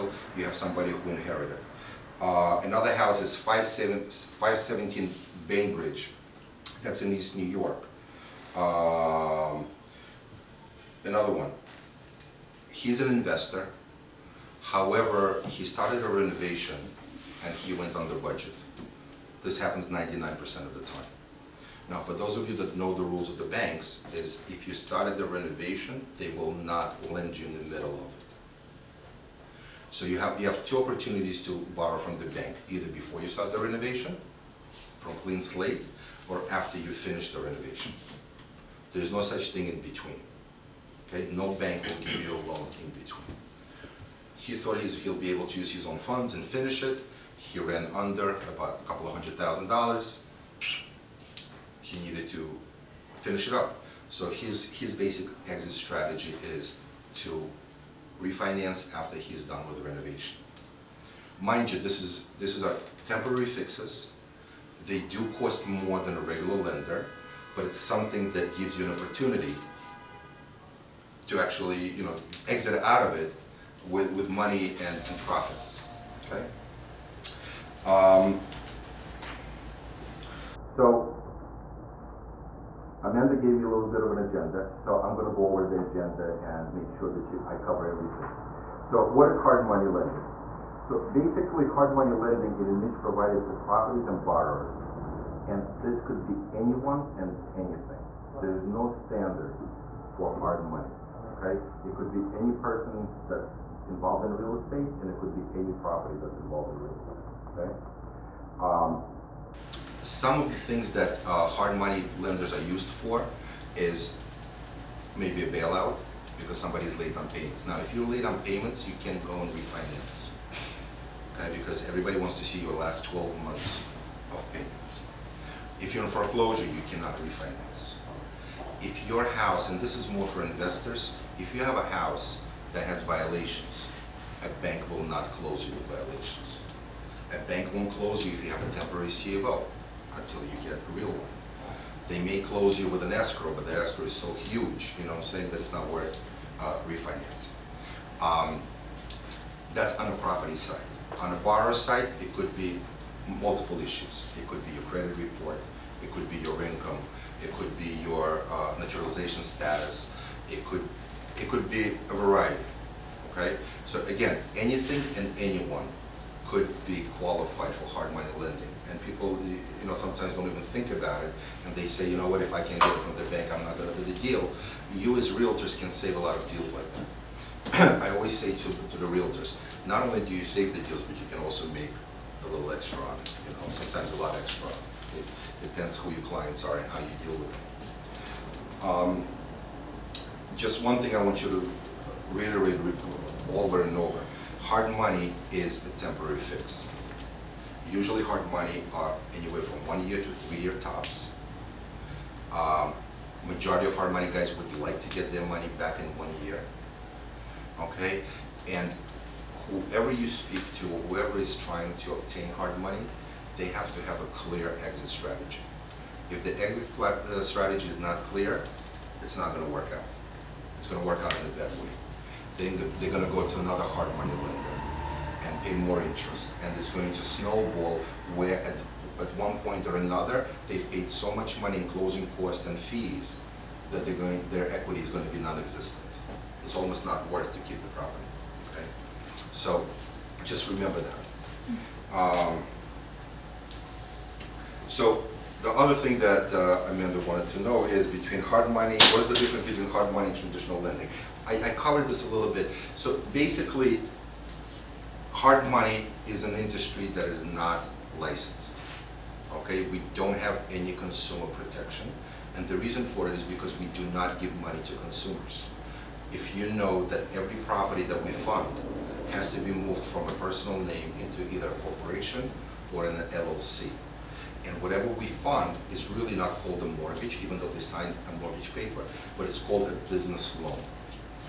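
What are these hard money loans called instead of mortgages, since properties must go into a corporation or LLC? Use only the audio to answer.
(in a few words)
business loan.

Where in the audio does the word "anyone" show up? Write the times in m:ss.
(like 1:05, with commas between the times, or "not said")
1:36, 2:45.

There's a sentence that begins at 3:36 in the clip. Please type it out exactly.
If the exit uh, strategy is not clear, it's not going to work out.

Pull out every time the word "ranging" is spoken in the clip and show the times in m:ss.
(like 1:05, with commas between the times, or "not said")
not said.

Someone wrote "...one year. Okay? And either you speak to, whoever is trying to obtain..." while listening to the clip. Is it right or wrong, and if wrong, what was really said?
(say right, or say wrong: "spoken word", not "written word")
wrong: "whoever", not "either".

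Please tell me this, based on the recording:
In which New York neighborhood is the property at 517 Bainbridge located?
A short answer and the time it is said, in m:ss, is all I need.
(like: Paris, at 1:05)
East New York, at 0:07.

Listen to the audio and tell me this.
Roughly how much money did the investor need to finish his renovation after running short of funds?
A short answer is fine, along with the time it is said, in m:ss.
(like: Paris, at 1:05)
a couple of hundred thousand dollars, at 0:48.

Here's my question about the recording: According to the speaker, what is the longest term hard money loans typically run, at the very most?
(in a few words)
3 years.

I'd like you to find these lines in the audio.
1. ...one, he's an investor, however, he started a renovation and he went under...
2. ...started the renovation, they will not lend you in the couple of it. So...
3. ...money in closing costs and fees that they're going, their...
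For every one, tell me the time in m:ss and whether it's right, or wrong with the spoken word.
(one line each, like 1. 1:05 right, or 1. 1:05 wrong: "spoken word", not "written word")
1. 0:11 right
2. 0:24 wrong: "middle", not "couple"
3. 3:51 right.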